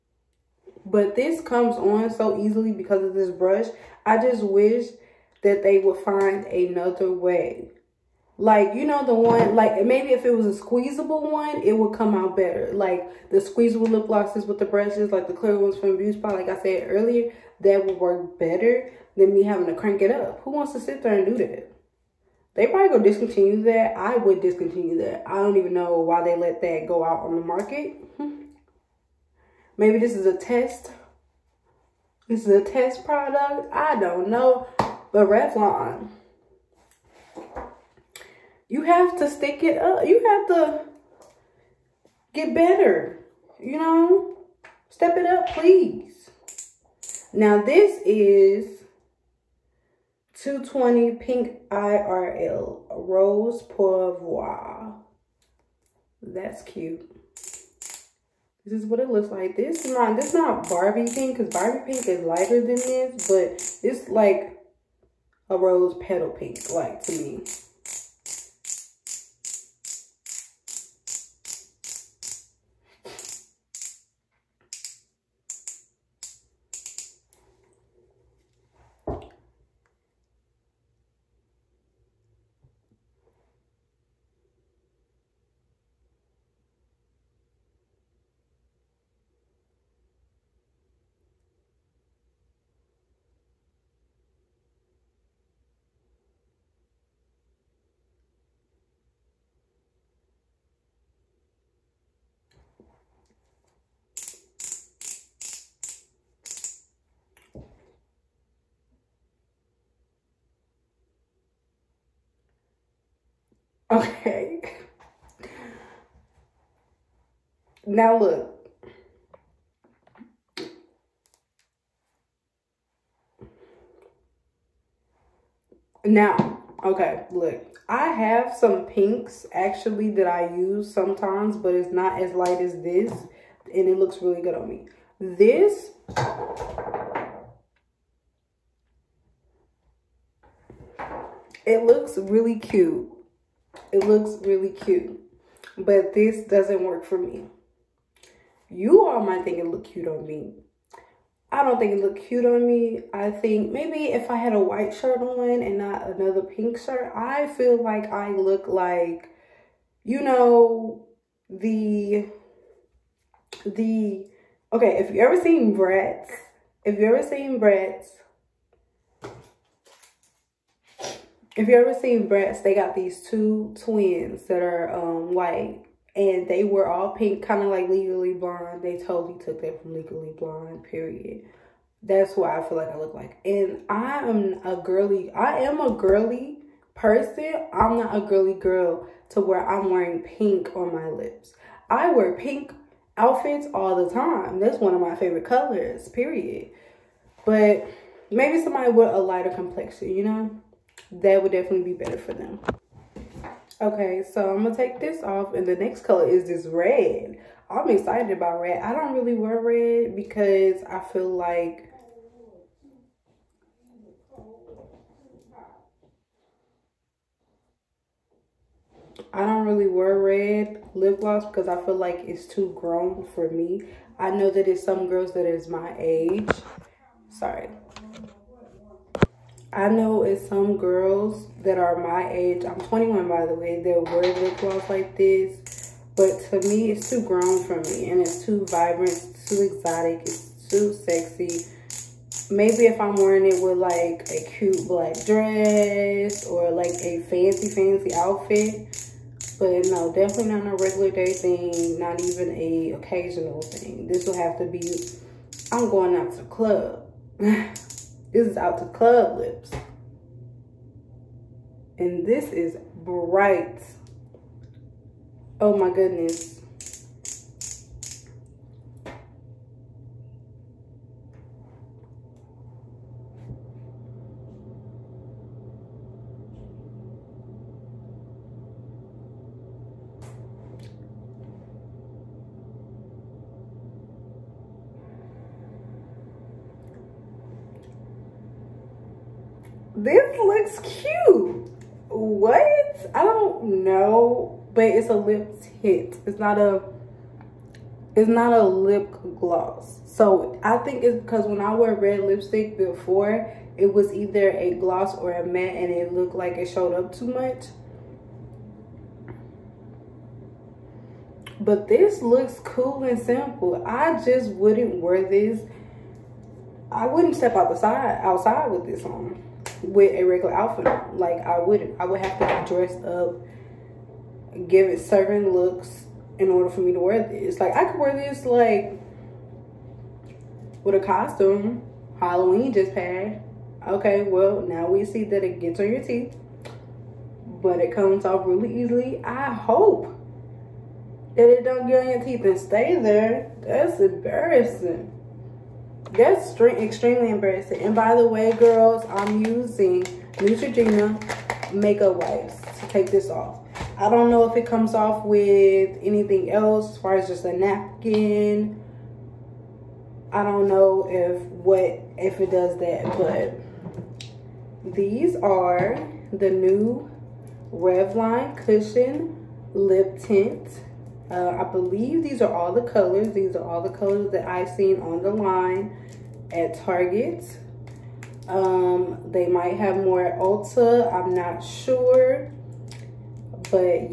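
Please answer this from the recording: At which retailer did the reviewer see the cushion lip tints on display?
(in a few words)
Target.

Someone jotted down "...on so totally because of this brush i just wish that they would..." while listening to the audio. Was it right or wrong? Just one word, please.
wrong.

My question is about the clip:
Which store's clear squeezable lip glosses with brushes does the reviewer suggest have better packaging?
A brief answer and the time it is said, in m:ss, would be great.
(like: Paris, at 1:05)
Beauty Spot, at 0:15.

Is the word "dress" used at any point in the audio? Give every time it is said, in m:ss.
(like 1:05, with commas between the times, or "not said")
4:05, 5:22.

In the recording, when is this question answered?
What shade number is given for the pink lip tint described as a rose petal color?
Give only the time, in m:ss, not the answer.
0:50.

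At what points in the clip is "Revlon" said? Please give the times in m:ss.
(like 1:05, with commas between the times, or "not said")
0:35, 6:07.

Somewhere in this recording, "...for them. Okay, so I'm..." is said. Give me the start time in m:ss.
3:22.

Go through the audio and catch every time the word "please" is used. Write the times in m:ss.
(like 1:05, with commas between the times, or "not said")
0:45.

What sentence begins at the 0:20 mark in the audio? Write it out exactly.
Who wants to sit there and do that?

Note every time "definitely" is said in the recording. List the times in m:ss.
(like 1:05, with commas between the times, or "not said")
3:21, 4:10.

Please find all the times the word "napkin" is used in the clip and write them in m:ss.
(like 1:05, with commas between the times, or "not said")
5:57.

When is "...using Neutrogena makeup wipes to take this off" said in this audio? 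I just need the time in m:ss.
5:49.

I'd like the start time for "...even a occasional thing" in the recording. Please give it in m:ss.
4:12.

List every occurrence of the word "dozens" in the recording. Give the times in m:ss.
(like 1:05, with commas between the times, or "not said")
not said.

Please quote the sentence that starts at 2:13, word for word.
And it looks really good on me.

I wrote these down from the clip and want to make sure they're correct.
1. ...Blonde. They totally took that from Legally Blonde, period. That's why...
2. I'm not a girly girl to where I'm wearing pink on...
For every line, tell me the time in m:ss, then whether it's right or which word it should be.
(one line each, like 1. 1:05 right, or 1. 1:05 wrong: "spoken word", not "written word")
1. 2:58 right
2. 3:07 right.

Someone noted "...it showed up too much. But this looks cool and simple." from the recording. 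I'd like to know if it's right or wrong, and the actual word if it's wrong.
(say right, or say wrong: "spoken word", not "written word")
right.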